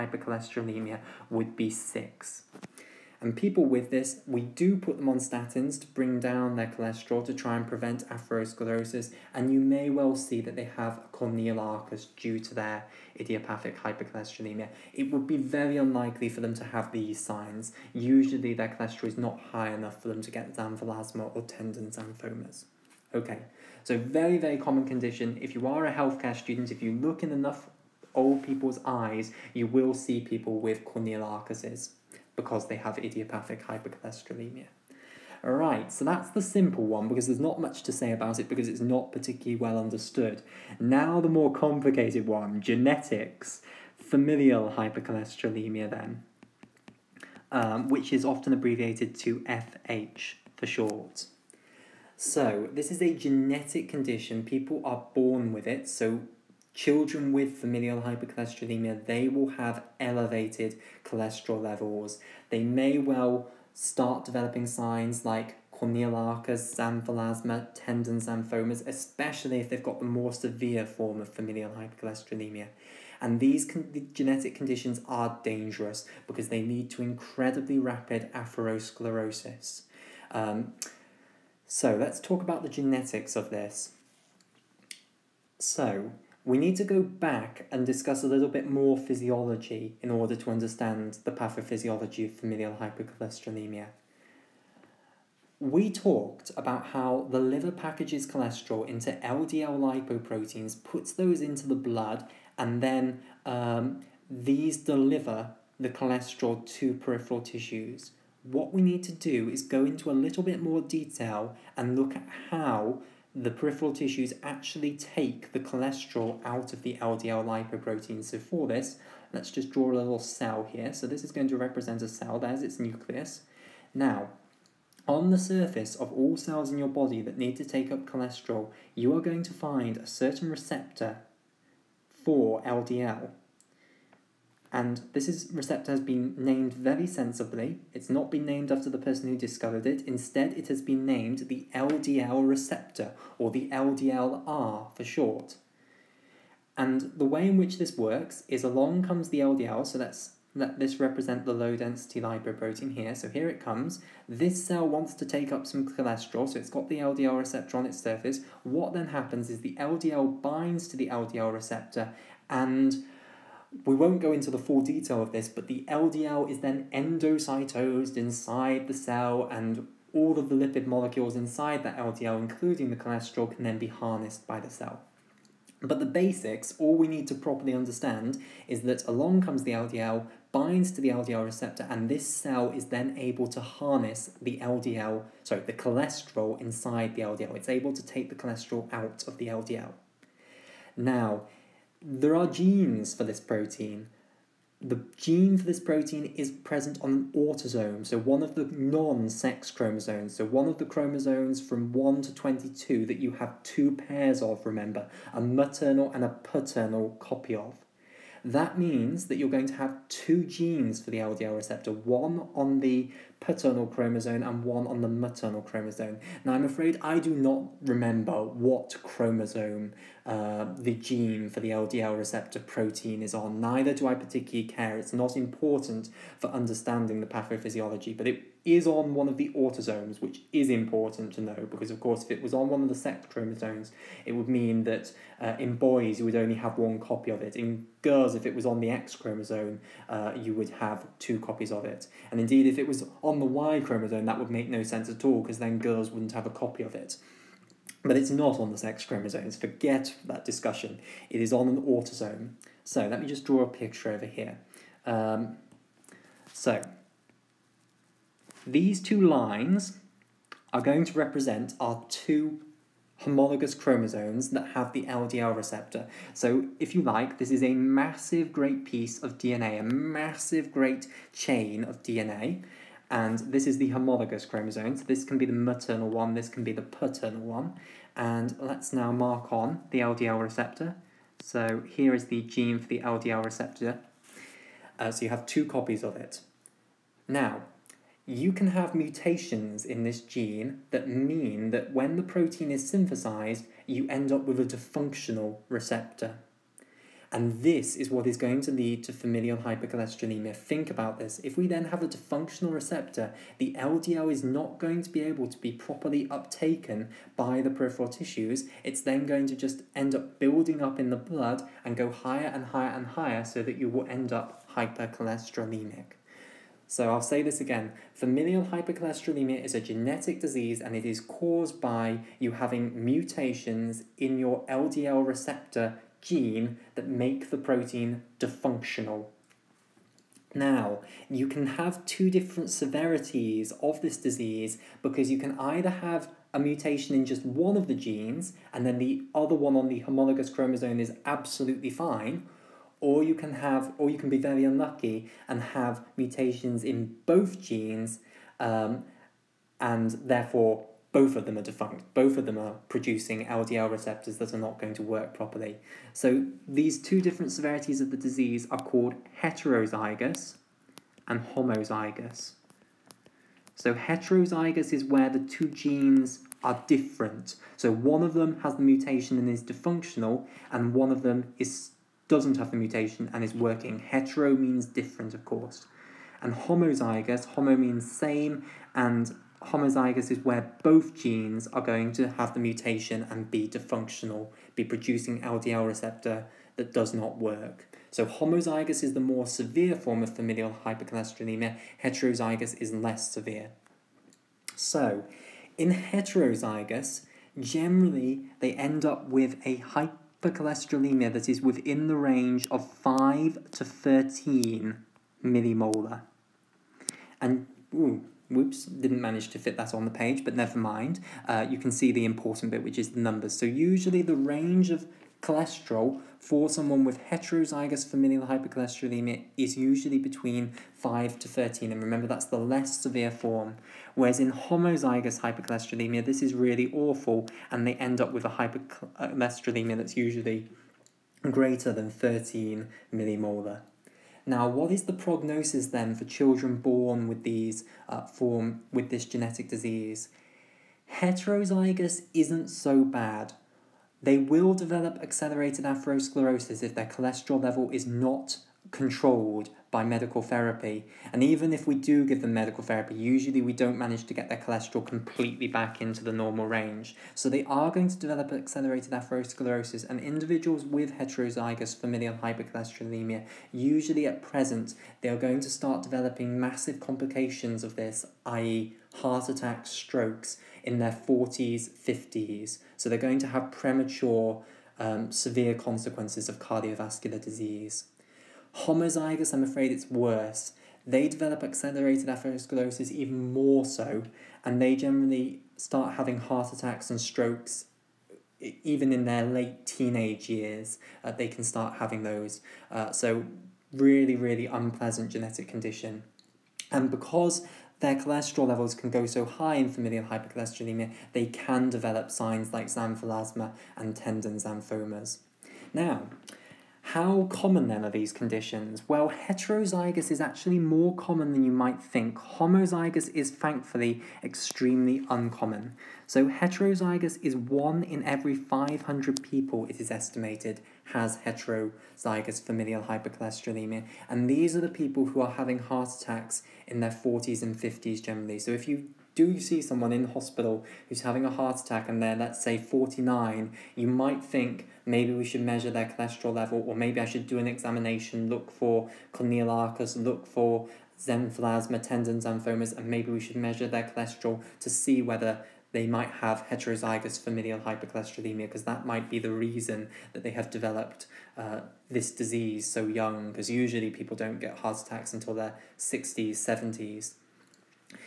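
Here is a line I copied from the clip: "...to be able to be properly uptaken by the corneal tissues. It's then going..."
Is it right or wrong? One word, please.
wrong.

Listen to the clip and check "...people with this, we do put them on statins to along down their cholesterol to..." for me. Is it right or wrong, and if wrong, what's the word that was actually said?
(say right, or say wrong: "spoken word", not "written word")
wrong: "bring", not "along".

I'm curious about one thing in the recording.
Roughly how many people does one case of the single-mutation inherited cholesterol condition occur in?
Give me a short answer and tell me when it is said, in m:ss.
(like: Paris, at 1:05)
500, at 8:37.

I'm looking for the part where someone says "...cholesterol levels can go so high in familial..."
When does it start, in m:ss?
8:18.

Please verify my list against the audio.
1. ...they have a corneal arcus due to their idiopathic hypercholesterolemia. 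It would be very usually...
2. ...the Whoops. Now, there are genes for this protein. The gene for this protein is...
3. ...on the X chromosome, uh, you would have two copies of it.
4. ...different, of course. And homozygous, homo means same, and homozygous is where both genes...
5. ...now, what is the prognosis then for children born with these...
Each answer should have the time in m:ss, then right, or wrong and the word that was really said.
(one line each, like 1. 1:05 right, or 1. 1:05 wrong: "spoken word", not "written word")
1. 0:10 wrong: "unlikely", not "usually"
2. 3:09 wrong: "LDL", not "Whoops"
3. 3:58 right
4. 6:14 right
5. 7:14 right.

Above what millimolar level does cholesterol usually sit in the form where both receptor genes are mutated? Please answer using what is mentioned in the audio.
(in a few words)
13 millimolar.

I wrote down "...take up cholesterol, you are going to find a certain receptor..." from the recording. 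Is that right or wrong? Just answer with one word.
right.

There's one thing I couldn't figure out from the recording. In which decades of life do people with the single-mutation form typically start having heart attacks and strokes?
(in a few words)
40s and 50s.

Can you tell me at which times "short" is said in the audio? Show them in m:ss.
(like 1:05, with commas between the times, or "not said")
0:50, 2:25.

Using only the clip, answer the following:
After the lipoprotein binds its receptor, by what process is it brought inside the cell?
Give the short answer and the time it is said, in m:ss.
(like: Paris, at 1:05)
Endocytosed, at 2:46.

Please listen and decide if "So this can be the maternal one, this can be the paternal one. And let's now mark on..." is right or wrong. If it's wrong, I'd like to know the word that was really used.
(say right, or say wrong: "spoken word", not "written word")
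right.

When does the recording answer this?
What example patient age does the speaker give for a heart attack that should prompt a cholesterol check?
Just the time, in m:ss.
8:52.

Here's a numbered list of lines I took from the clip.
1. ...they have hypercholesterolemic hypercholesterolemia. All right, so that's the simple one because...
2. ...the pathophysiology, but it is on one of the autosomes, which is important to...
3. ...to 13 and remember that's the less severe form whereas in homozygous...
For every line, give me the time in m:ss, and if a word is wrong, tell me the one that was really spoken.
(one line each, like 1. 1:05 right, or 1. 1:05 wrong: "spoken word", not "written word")
1. 0:32 wrong: "idiopathic", not "hypercholesterolemic"
2. 3:47 right
3. 7:01 right.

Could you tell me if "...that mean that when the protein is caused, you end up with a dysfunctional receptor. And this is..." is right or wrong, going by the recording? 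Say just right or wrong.
wrong.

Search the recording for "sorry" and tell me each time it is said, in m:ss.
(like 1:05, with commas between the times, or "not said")
3:05.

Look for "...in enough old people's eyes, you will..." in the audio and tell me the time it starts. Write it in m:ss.
0:27.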